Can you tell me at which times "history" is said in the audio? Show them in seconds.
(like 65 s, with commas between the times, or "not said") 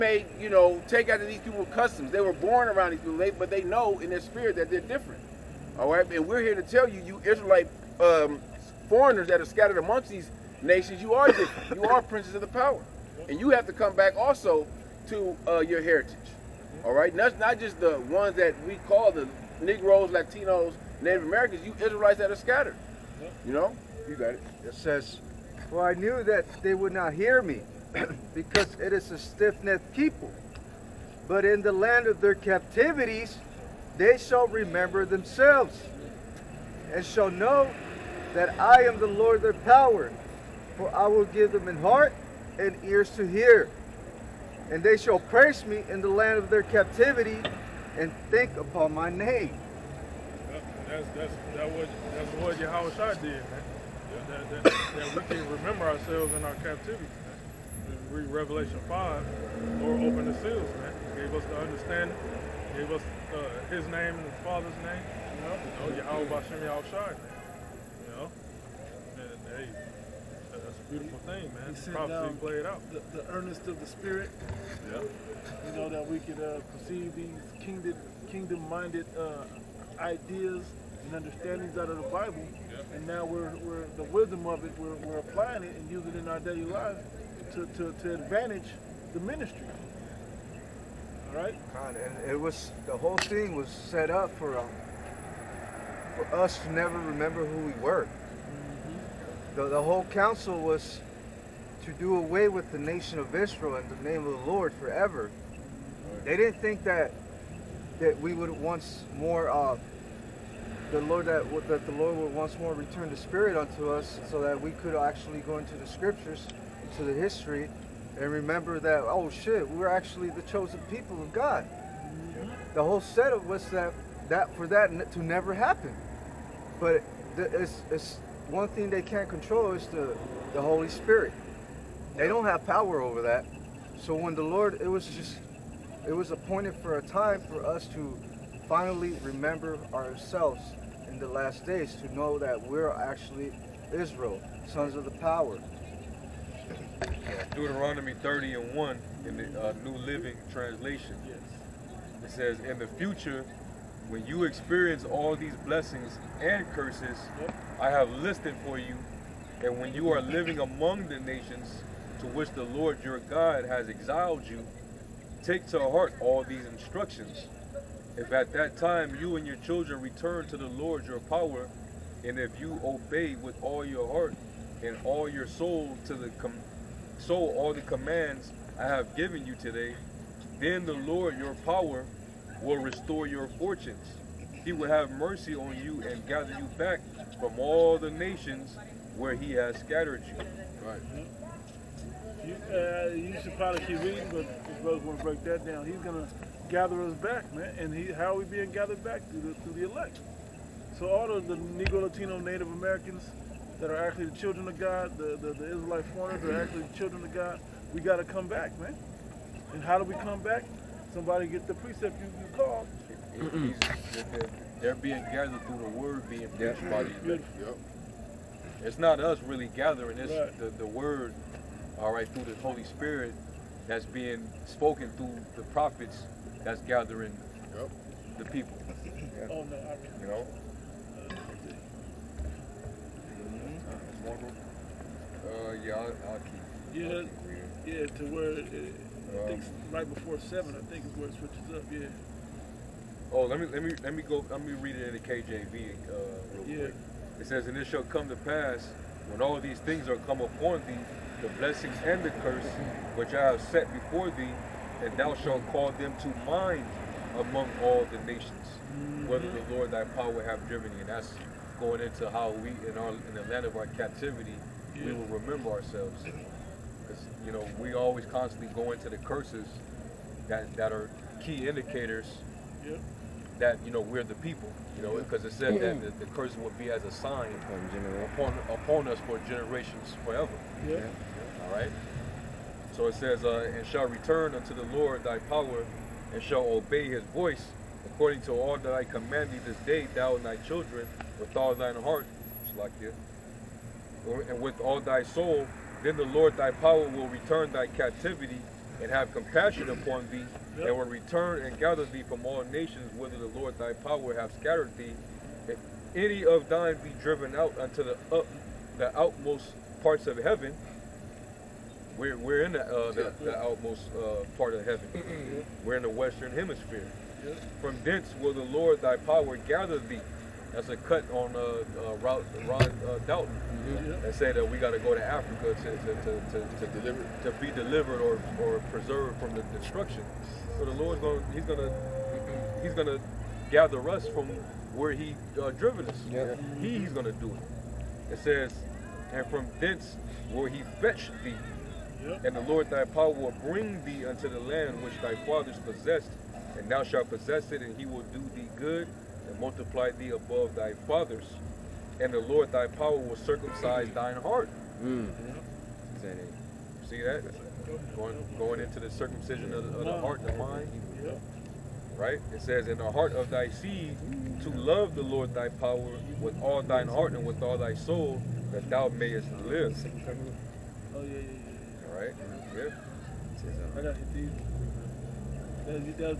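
117 s.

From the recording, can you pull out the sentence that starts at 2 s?
They were born around these people, they, but they know in their spirit that they're different.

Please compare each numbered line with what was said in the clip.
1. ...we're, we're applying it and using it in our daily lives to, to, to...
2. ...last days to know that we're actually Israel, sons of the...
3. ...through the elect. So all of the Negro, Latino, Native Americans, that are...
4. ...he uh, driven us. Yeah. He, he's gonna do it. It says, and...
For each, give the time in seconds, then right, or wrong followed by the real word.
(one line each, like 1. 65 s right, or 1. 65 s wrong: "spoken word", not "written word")
1. 84 s right
2. 141 s right
3. 199 s right
4. 335 s right.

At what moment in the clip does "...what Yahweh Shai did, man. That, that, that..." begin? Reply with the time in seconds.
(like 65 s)
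52 s.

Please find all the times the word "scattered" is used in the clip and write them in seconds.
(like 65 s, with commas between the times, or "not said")
9 s, 22 s, 189 s, 304 s.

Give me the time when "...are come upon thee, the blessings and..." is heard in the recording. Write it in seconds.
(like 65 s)
250 s.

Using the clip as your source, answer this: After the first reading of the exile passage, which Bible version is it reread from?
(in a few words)
KJV.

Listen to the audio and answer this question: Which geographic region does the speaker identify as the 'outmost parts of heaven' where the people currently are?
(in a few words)
The western hemisphere.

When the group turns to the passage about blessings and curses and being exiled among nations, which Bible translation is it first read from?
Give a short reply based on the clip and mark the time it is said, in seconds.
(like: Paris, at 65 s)
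New Living Translation, at 149 s.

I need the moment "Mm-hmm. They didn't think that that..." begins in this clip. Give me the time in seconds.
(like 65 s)
105 s.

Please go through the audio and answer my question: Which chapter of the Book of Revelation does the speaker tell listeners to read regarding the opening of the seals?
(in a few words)
Revelation 5.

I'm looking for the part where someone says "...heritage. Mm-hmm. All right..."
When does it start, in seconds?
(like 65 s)
15 s.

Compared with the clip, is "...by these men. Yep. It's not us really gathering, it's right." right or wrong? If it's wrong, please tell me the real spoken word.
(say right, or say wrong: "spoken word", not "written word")
right.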